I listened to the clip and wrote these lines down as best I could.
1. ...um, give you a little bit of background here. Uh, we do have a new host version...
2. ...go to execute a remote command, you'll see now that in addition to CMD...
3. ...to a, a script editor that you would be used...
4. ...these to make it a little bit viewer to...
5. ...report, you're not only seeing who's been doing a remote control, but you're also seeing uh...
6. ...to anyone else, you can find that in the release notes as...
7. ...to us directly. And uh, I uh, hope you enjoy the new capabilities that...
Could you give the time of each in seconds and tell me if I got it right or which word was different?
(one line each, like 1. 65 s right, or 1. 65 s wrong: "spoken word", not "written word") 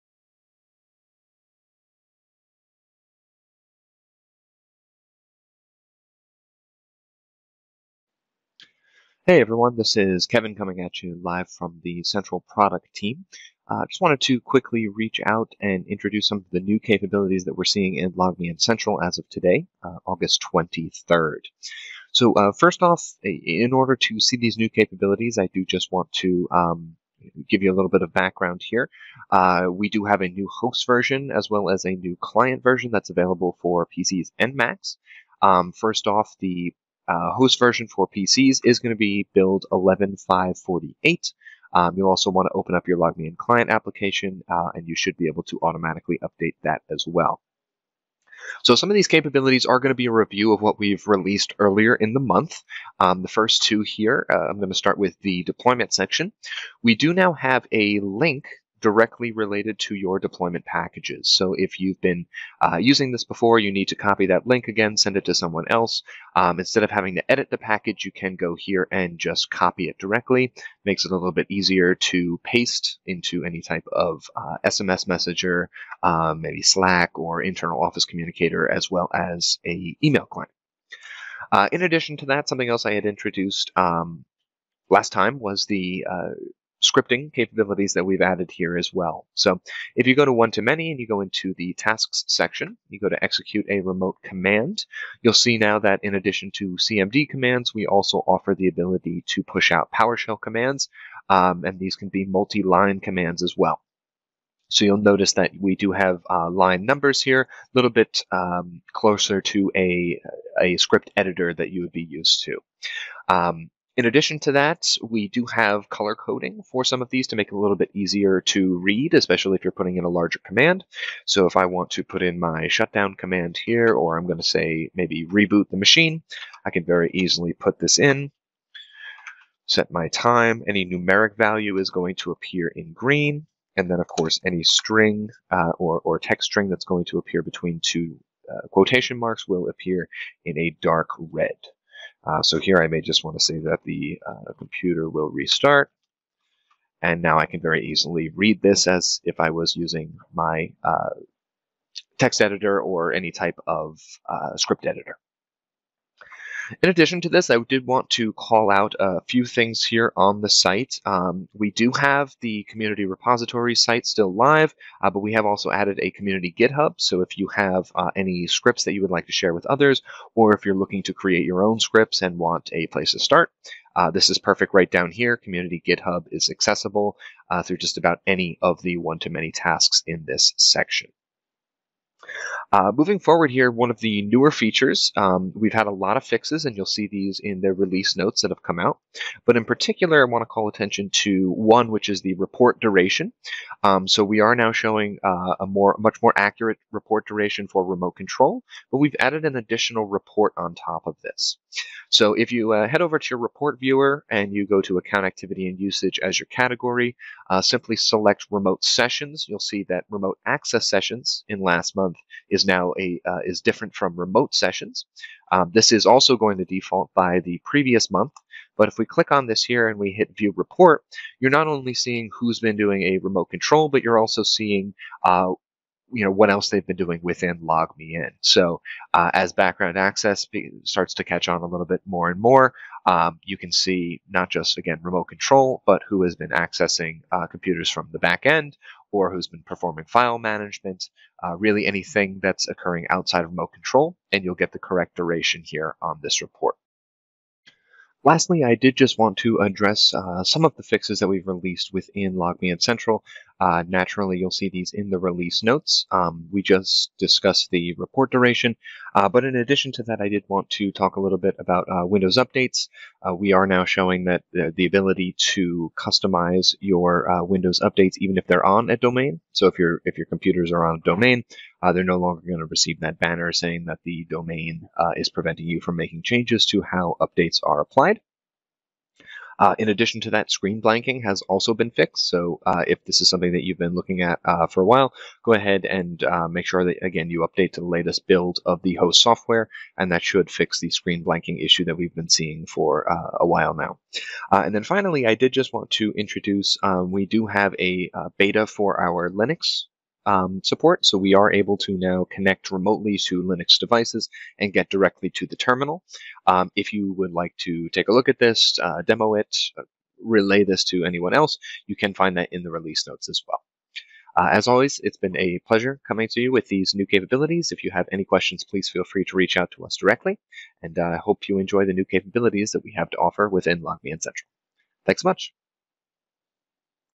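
1. 26 s right
2. 92 s right
3. 109 s right
4. 117 s wrong: "easier", not "viewer"
5. 220 s right
6. 310 s right
7. 319 s right.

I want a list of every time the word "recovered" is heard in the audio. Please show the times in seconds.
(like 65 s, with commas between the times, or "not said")
not said.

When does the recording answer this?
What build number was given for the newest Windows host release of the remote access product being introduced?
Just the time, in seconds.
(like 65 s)
39 s.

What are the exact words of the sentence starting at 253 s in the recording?
Uh, naturally, you'll see these in the release notes.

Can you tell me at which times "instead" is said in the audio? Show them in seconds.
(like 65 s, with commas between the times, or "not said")
66 s.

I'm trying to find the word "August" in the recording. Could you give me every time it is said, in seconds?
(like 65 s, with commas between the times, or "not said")
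20 s.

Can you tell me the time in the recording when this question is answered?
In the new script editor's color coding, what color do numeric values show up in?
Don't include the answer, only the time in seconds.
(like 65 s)
132 s.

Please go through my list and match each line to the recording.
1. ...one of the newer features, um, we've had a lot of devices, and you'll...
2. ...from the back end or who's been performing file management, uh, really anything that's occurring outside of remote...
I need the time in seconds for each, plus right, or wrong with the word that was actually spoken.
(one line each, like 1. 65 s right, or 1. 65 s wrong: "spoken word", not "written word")
1. 183 s wrong: "fixes", not "devices"
2. 237 s right.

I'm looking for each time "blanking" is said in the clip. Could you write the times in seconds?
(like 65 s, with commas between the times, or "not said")
280 s, 291 s.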